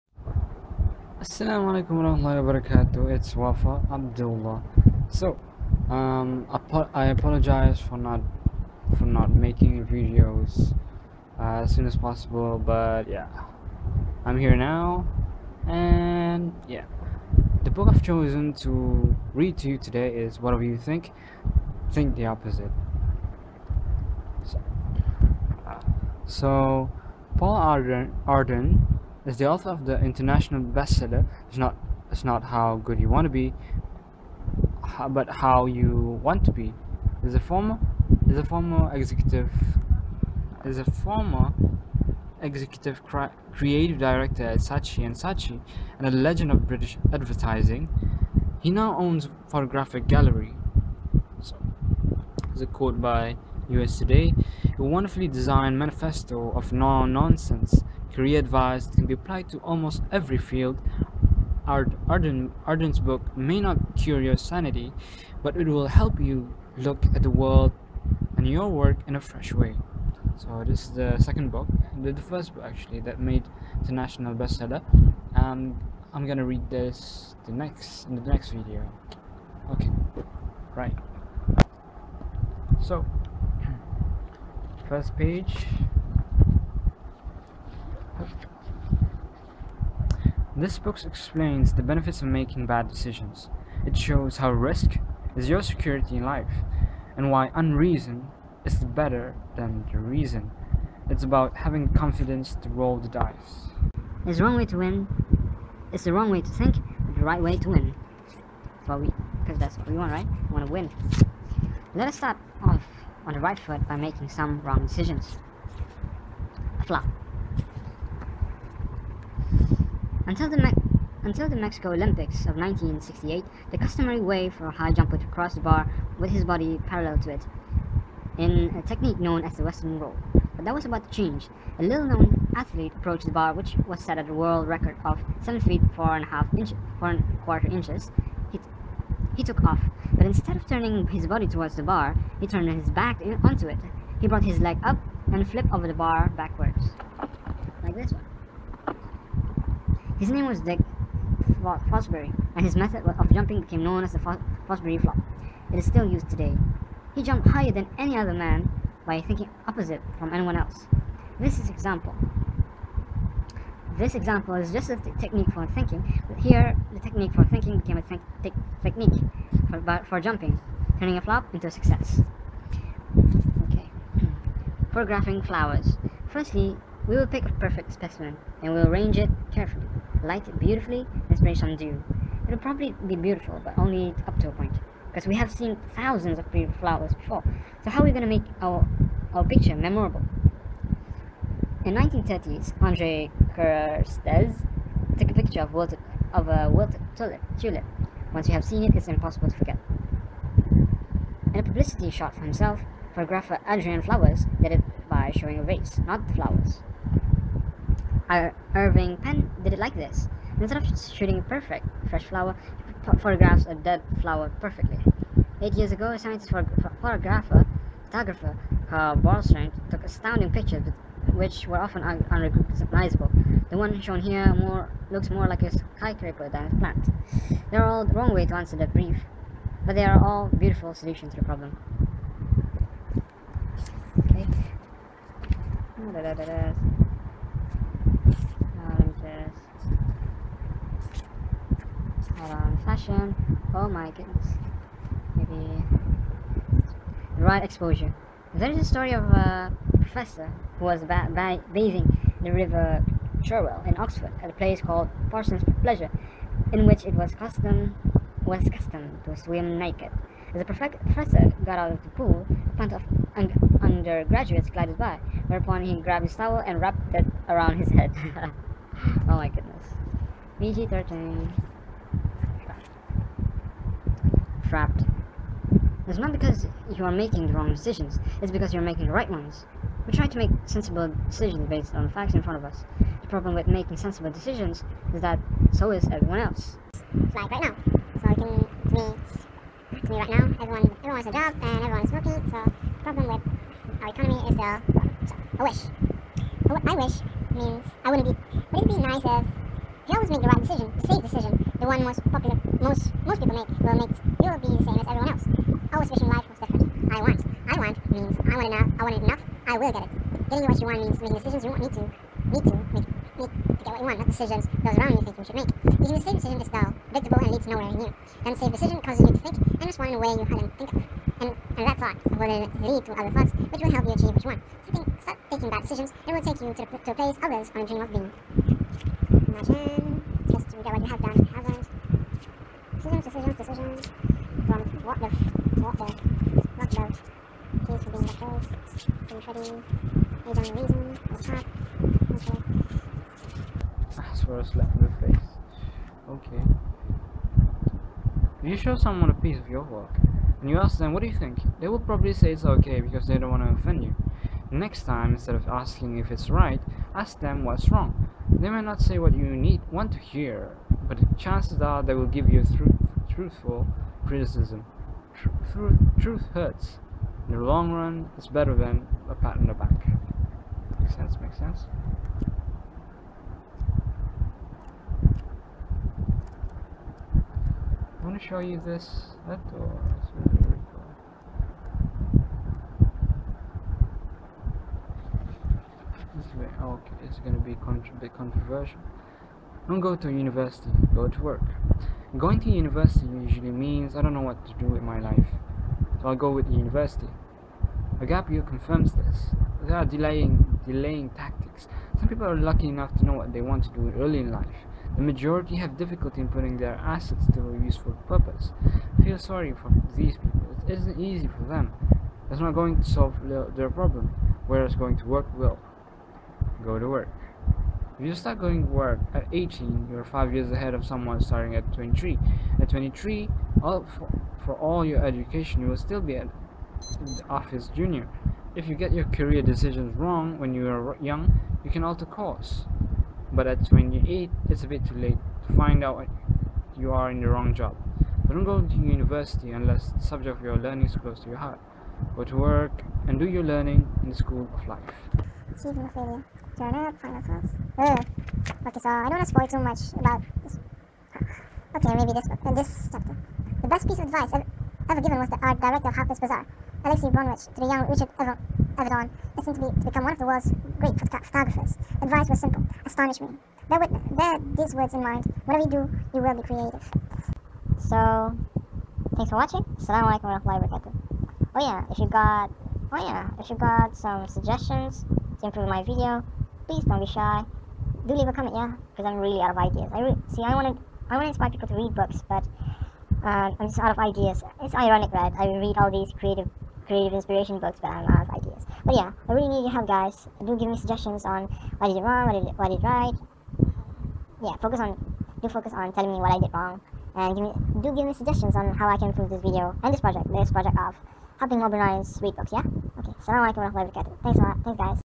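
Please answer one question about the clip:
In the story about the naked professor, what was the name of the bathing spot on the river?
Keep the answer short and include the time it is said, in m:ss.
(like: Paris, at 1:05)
Parsons Pleasure, at 4:15.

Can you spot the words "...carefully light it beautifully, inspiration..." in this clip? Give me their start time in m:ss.
2:59.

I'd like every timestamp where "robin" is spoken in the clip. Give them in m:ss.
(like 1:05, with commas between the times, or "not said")
not said.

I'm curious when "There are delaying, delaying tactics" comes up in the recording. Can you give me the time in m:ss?
6:39.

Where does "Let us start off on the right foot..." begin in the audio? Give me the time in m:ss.
1:51.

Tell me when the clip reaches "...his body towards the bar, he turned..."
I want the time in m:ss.
2:21.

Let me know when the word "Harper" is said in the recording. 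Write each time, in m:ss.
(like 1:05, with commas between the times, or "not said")
7:36.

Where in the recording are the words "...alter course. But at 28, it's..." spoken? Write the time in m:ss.
7:12.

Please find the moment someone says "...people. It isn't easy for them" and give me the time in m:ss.
6:50.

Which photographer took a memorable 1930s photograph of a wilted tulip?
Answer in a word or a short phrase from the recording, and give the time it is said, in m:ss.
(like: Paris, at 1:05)
Andre Kertész, at 3:12.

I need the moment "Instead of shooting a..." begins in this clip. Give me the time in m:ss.
3:30.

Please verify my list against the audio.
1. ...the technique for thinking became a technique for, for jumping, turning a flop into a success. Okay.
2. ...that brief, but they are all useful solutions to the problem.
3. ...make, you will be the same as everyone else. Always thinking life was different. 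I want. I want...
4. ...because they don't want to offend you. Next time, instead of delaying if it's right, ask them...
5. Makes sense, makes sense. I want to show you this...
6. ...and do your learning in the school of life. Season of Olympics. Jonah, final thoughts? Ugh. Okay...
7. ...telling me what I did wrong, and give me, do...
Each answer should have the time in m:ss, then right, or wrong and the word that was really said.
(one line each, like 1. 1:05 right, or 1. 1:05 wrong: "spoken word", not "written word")
1. 2:46 right
2. 3:48 wrong: "beautiful", not "useful"
3. 5:03 wrong: "wishing", not "thinking"
4. 5:53 wrong: "asking", not "delaying"
5. 6:10 right
6. 7:23 wrong: "Failure", not "Olympics"
7. 8:16 right.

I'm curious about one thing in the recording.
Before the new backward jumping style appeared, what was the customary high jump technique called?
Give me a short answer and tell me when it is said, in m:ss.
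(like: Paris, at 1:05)
Western Roll, at 2:09.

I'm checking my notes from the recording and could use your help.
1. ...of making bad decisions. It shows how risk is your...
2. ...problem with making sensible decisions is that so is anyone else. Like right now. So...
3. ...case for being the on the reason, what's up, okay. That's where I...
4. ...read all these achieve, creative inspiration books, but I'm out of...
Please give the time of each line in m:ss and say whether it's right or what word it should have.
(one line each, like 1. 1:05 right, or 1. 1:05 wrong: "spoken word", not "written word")
1. 1:32 right
2. 4:43 wrong: "everyone", not "anyone"
3. 5:37 right
4. 8:05 wrong: "creative", not "achieve".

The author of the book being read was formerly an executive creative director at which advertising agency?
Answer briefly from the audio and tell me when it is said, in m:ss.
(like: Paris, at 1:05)
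Saatchi and Saatchi, at 0:44.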